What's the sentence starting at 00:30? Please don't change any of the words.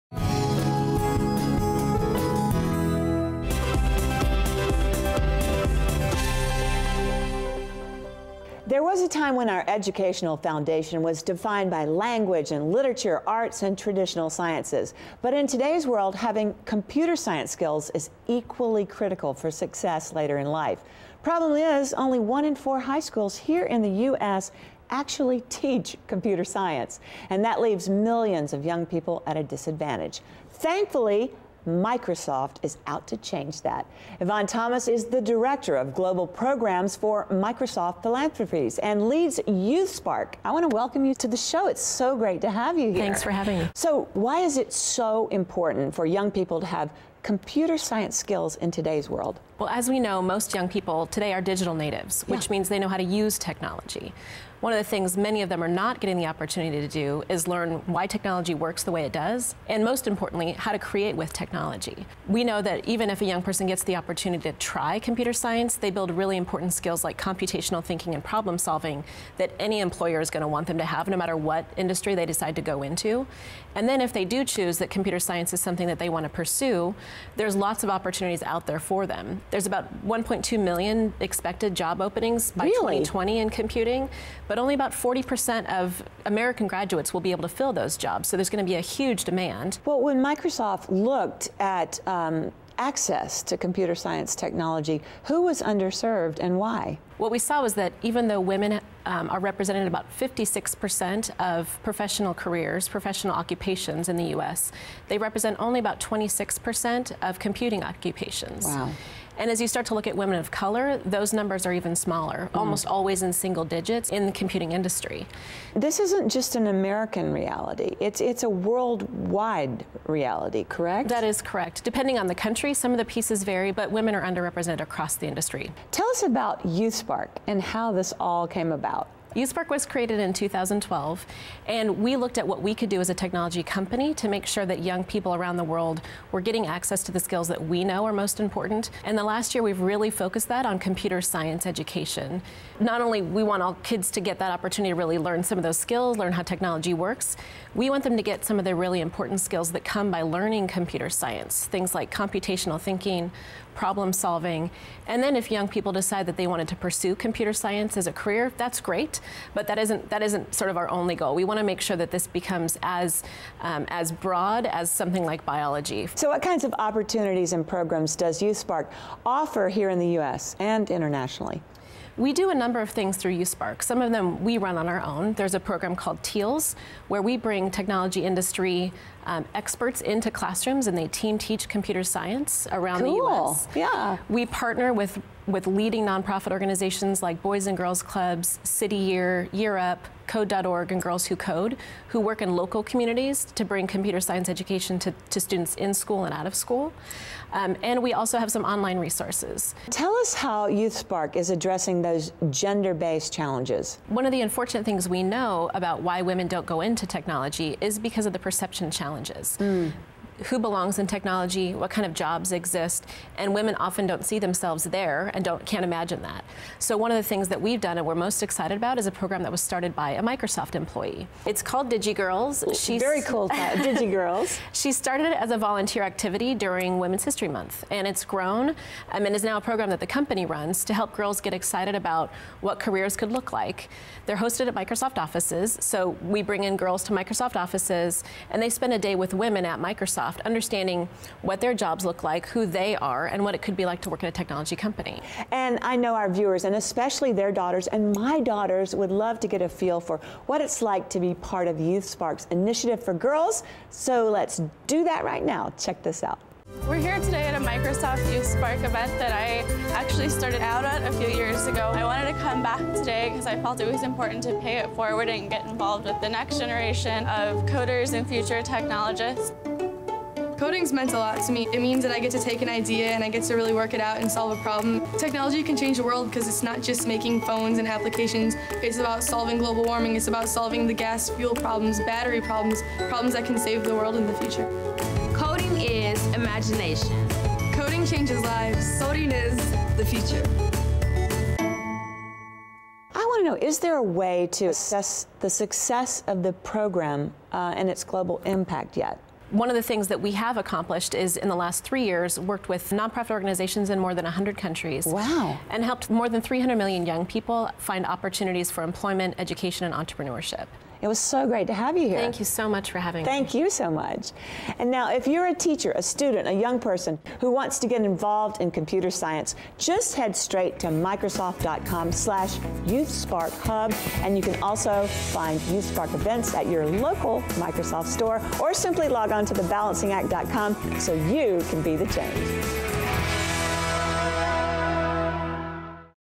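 Thankfully, Microsoft is out to change that.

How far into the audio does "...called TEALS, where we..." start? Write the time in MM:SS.
02:55.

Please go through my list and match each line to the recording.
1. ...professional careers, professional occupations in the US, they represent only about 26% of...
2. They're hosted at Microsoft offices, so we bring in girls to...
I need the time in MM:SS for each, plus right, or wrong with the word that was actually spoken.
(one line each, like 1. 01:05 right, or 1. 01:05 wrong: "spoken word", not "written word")
1. 01:41 right
2. 03:54 right.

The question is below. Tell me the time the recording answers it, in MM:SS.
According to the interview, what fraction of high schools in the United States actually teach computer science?
00:22.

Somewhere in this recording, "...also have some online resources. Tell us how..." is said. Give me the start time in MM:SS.
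03:18.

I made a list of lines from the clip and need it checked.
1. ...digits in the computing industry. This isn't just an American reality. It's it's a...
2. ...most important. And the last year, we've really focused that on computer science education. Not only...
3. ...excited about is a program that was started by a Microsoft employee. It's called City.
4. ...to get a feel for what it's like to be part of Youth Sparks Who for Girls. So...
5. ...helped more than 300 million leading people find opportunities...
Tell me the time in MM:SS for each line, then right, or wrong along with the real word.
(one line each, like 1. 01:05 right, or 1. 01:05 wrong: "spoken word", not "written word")
1. 01:53 right
2. 02:18 right
3. 03:38 wrong: "DigiGirls", not "City"
4. 04:09 wrong: "Initiative", not "Who"
5. 05:05 wrong: "young", not "leading".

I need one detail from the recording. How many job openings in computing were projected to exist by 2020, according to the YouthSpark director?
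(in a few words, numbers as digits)
1.2 million.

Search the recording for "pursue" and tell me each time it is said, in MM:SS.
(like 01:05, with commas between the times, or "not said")
01:16, 02:36.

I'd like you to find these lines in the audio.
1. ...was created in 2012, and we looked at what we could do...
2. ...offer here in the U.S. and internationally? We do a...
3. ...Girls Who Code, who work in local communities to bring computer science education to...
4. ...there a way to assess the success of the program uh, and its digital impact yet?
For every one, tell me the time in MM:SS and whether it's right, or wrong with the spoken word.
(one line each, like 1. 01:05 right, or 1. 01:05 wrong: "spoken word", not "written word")
1. 02:09 right
2. 02:49 right
3. 03:11 right
4. 04:53 wrong: "global", not "digital".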